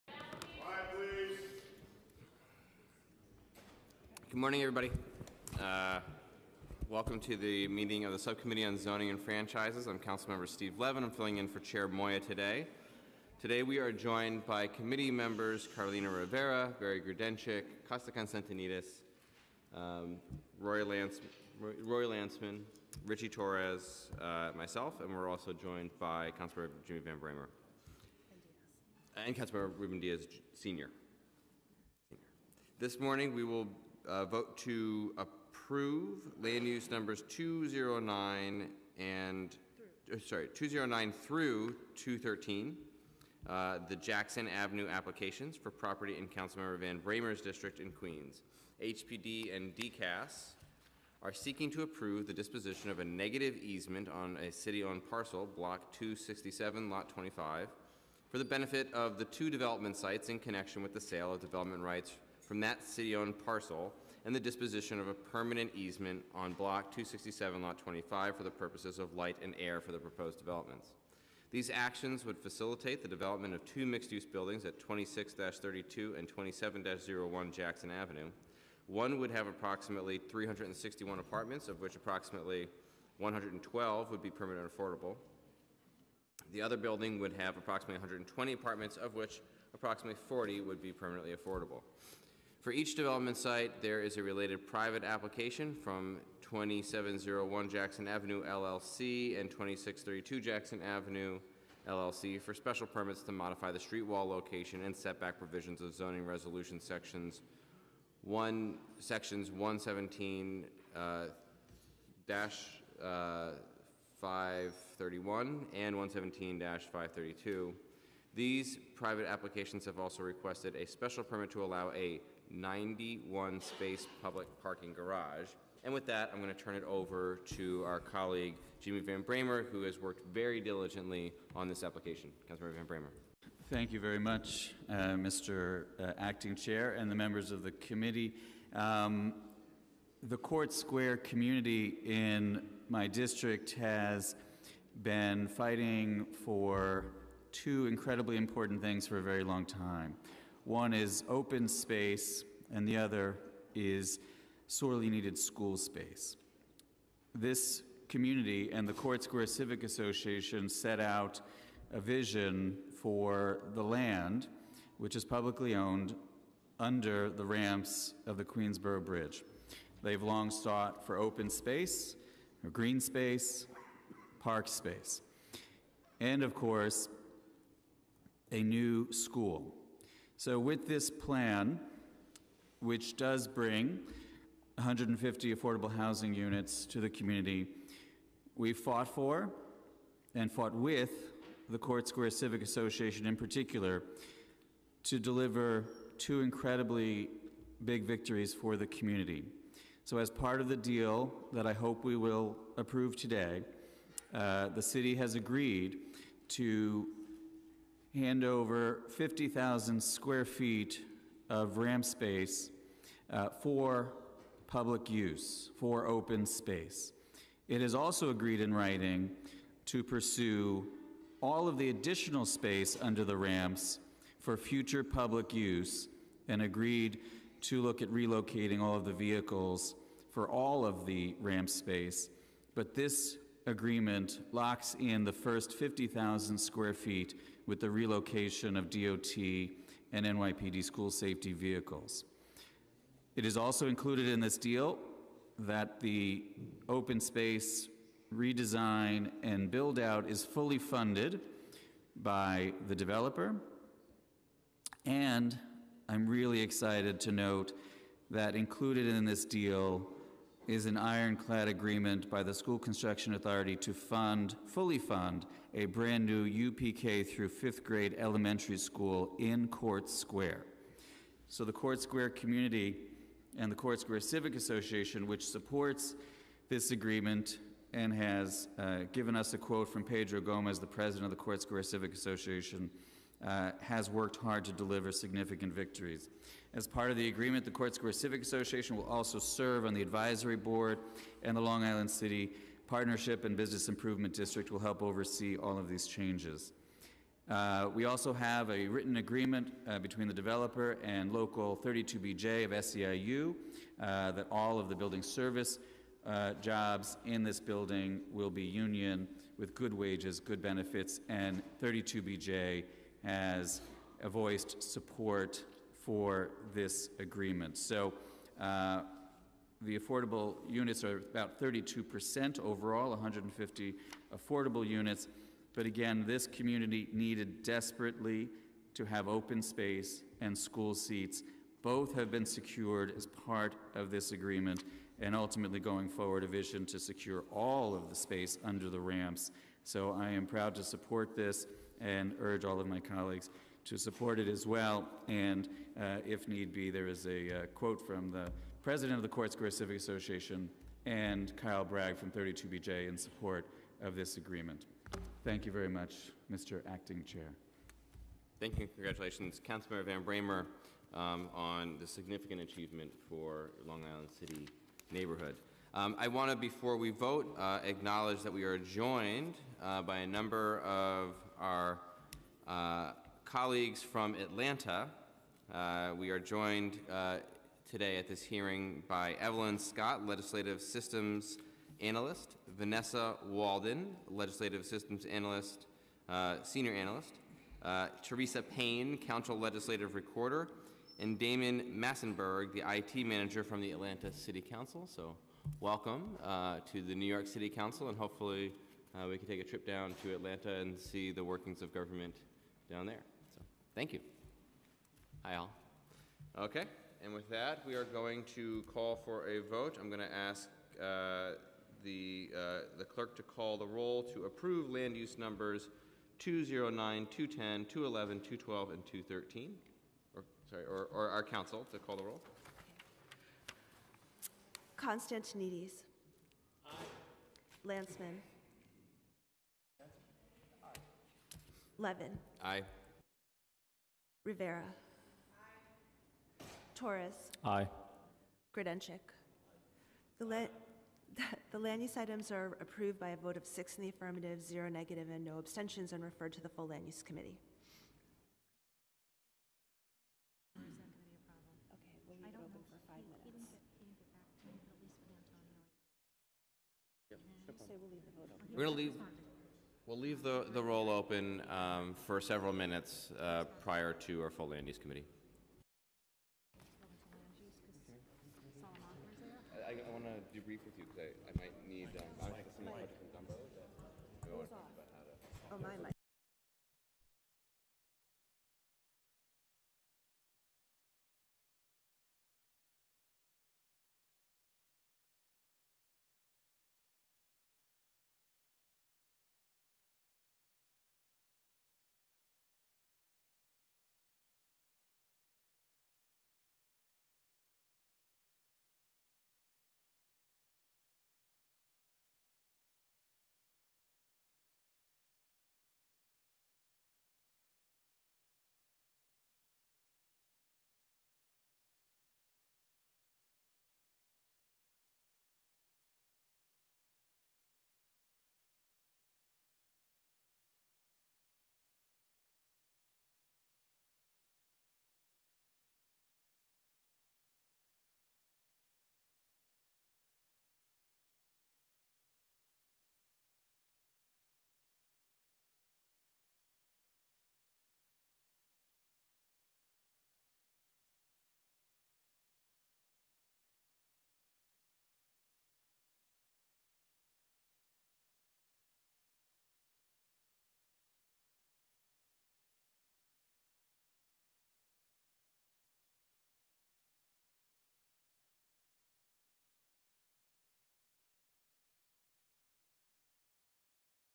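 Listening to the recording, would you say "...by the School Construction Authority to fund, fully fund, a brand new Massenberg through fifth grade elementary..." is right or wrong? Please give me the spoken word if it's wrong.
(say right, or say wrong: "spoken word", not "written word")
wrong: "UPK", not "Massenberg".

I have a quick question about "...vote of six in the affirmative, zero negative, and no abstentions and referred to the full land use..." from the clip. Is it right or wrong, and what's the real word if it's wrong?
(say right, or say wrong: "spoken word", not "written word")
right.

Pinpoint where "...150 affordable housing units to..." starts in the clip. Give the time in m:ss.
3:04.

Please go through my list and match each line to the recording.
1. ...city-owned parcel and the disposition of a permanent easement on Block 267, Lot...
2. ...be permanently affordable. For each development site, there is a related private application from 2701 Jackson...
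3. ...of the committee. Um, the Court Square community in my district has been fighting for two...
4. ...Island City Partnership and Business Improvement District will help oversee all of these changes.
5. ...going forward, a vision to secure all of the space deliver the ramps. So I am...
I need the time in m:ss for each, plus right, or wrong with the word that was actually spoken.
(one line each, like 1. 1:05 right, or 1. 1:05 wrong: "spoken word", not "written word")
1. 1:02 right
2. 1:30 right
3. 2:17 right
4. 4:51 right
5. 5:35 wrong: "under", not "deliver".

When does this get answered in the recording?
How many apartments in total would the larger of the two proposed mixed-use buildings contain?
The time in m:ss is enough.
1:20.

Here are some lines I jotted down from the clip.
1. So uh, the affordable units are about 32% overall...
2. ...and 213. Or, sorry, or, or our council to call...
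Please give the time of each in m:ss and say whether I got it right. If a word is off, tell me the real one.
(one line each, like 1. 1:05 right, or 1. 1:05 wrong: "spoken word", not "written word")
1. 5:17 right
2. 6:58 right.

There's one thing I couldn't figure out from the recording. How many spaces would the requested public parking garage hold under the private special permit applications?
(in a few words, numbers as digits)
91.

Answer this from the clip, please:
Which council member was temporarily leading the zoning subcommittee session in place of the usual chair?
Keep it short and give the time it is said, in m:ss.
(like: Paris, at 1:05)
Steve Levin, at 0:10.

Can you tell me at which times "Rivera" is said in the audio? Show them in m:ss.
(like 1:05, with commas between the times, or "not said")
0:16, 7:14.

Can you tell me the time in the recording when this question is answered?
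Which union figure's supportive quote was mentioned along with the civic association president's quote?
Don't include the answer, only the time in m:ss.
5:51.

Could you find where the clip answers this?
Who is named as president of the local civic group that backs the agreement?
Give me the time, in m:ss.
4:40.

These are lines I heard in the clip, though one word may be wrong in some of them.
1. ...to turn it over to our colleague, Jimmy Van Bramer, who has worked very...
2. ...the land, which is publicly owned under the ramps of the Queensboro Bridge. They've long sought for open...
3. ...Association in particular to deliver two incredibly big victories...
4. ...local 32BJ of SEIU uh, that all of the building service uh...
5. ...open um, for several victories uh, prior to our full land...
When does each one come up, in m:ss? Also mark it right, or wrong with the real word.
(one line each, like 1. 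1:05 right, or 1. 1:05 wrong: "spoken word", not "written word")
1. 2:06 right
2. 2:43 right
3. 3:12 right
4. 5:01 right
5. 7:41 wrong: "minutes", not "victories".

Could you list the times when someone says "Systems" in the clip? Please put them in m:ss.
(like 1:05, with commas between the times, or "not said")
6:20, 6:24.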